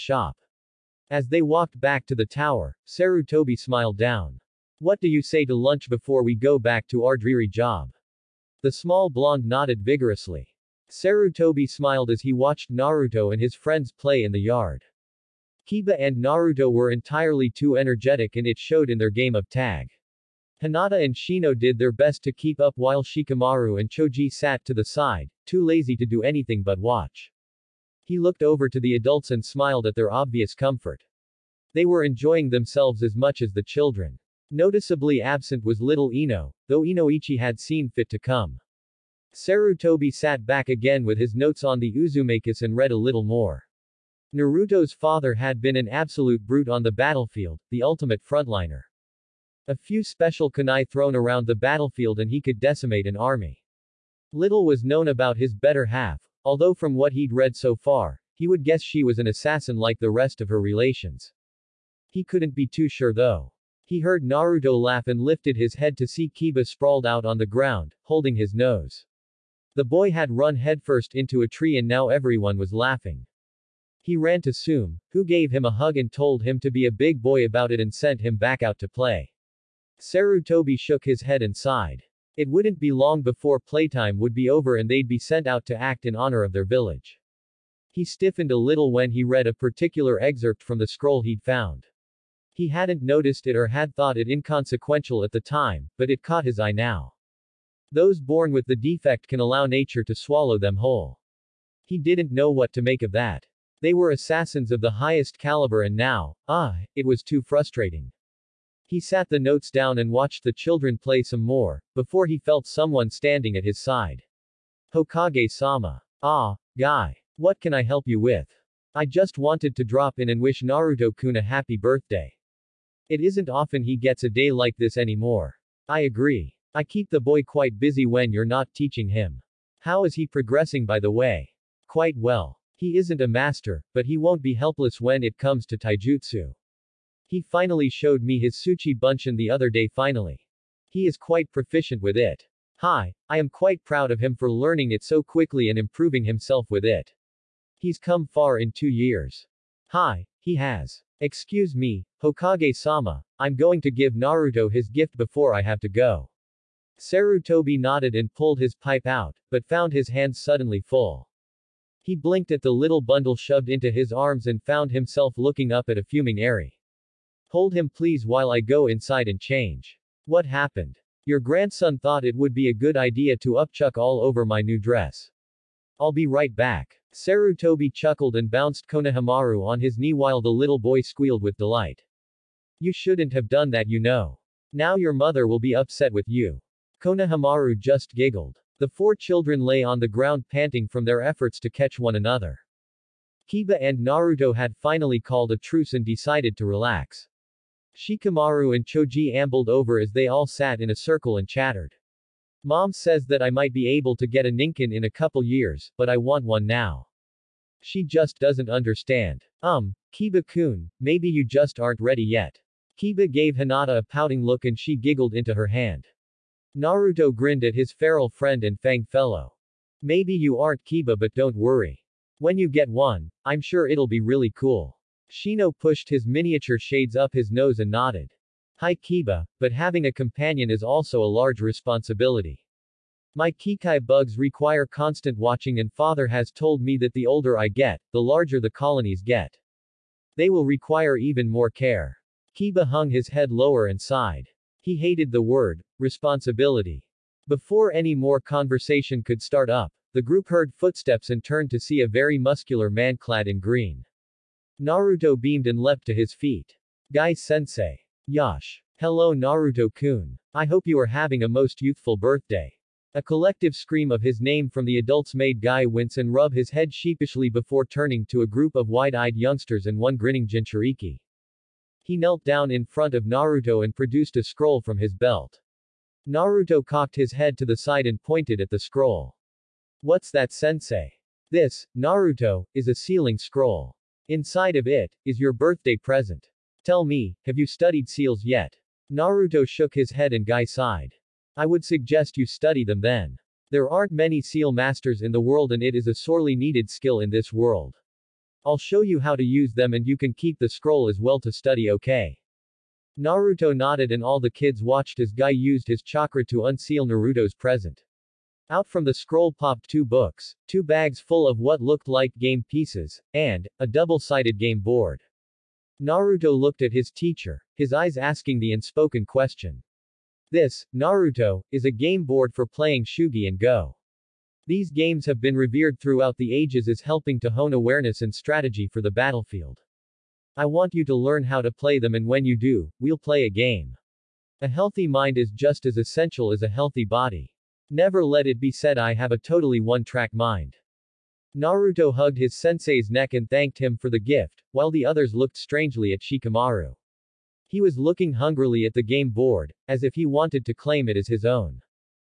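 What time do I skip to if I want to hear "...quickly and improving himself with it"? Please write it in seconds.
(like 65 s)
145 s.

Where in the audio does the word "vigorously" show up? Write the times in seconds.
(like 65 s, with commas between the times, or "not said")
9 s.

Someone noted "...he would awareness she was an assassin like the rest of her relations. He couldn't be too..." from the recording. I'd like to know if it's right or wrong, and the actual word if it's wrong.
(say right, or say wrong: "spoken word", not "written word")
wrong: "guess", not "awareness".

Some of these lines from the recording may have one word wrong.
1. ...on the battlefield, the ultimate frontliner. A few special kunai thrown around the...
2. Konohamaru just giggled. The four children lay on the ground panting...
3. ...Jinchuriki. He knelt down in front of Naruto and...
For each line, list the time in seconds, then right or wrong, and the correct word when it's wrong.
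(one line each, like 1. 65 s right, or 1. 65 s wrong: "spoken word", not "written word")
1. 46 s right
2. 187 s right
3. 270 s right.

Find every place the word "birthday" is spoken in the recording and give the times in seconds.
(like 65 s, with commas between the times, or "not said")
121 s, 262 s, 285 s.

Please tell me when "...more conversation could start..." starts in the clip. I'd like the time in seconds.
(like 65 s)
248 s.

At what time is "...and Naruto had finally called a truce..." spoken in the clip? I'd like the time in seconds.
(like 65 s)
193 s.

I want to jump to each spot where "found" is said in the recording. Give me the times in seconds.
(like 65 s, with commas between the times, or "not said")
91 s, 159 s, 164 s.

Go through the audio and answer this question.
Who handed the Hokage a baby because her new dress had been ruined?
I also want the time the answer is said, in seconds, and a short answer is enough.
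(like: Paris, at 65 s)
Eri, at 166 s.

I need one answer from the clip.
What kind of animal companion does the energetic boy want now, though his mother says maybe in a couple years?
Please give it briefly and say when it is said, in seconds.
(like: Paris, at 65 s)
Ninken, at 204 s.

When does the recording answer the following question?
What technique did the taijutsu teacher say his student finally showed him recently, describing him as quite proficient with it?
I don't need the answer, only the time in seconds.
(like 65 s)
138 s.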